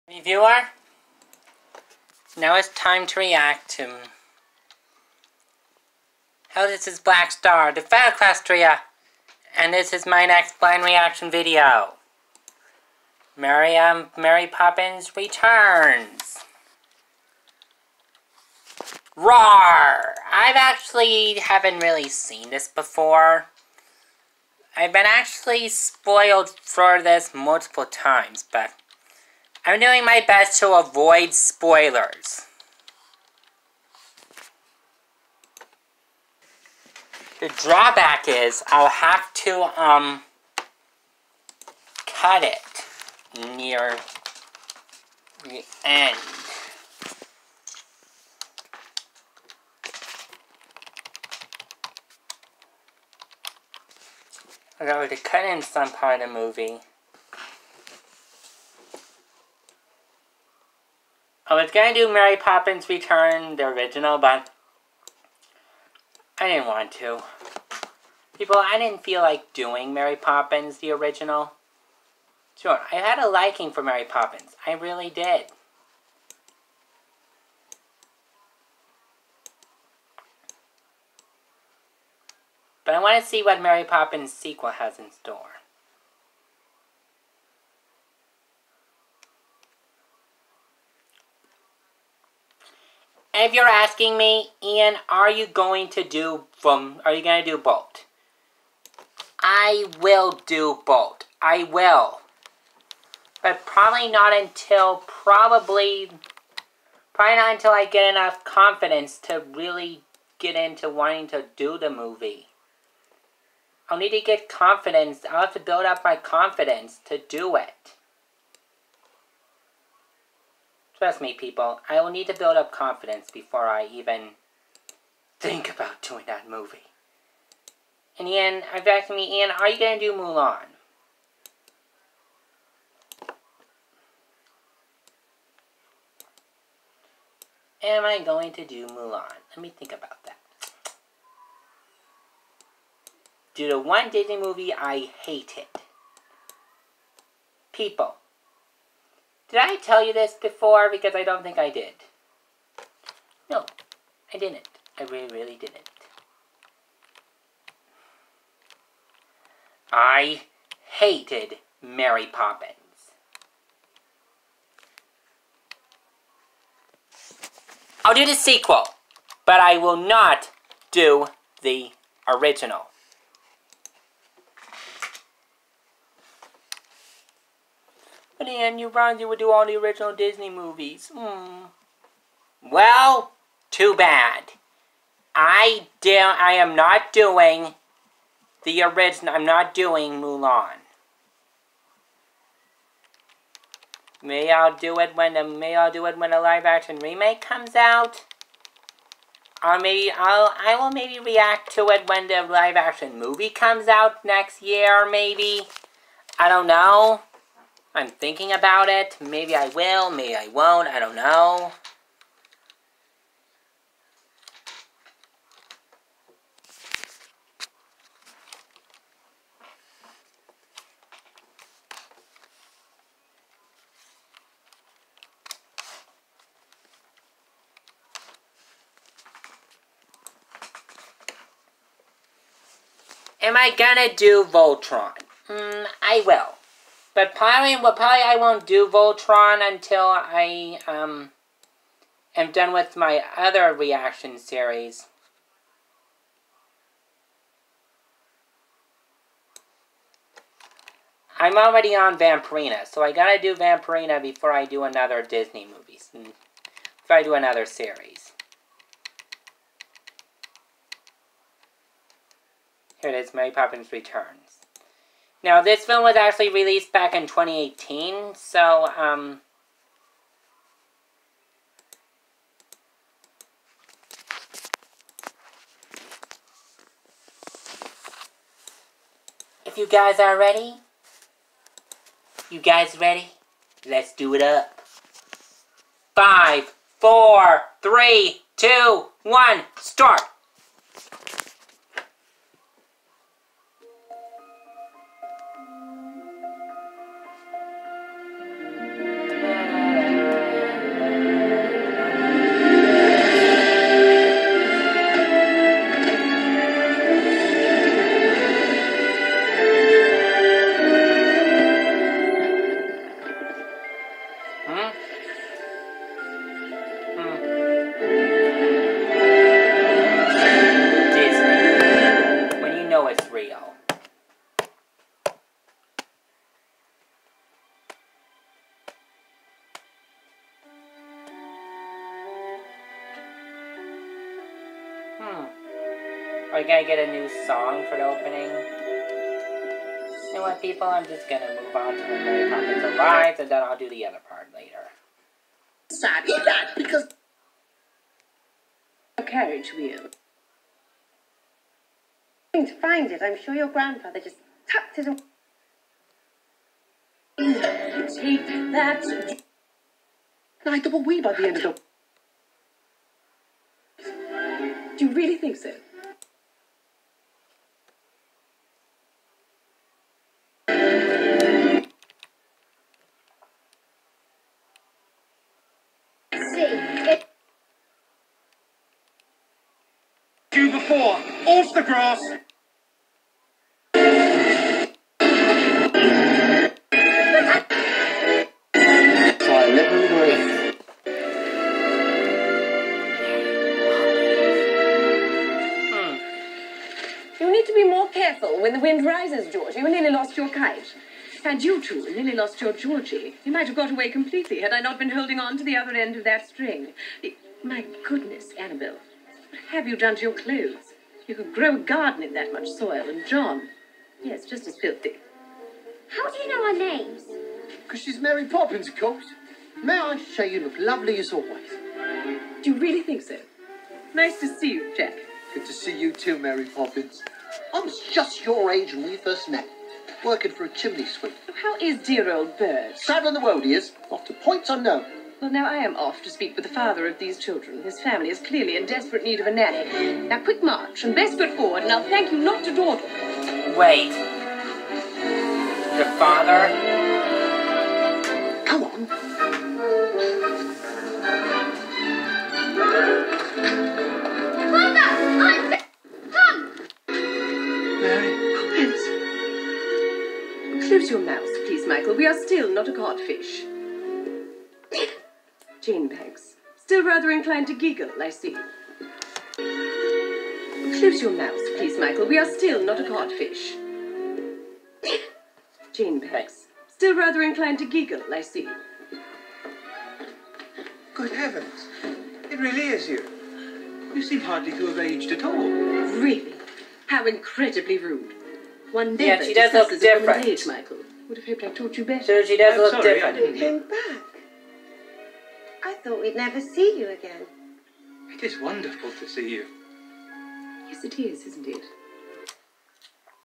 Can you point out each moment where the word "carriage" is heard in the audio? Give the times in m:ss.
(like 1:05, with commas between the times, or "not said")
5:49.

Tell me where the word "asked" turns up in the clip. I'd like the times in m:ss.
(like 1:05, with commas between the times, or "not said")
2:08.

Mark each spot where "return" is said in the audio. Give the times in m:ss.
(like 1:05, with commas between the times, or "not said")
0:15, 1:02, 4:23.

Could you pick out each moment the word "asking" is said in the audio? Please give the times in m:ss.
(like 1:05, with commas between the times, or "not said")
1:33.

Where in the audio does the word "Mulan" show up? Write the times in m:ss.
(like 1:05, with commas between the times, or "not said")
2:10, 2:18, 3:10.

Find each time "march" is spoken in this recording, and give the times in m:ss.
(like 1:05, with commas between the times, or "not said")
7:20.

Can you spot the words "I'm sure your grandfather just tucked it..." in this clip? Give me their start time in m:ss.
5:53.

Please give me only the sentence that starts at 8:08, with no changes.
One never yeah, she does look different.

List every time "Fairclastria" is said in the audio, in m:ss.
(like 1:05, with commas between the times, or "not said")
0:07.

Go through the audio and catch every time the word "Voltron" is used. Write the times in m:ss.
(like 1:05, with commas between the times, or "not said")
3:54, 3:58.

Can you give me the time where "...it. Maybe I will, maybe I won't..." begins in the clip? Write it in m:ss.
3:28.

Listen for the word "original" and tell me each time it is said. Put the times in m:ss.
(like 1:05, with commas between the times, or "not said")
1:03, 1:10, 2:52, 2:59, 3:08.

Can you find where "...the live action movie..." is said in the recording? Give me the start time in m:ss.
3:22.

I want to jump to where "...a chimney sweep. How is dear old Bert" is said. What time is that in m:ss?
7:10.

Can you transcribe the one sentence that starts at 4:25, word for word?
Now, this film was actually released back in 2018, so, um...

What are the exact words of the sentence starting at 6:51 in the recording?
You could grow a garden in that much soil, and John.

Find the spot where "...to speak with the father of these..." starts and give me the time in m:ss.
7:16.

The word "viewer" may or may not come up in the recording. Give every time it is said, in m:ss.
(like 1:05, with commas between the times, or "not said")
0:00.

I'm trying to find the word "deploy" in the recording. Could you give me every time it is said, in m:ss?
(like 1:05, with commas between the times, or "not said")
not said.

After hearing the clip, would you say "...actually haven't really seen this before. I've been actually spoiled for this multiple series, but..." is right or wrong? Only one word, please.
wrong.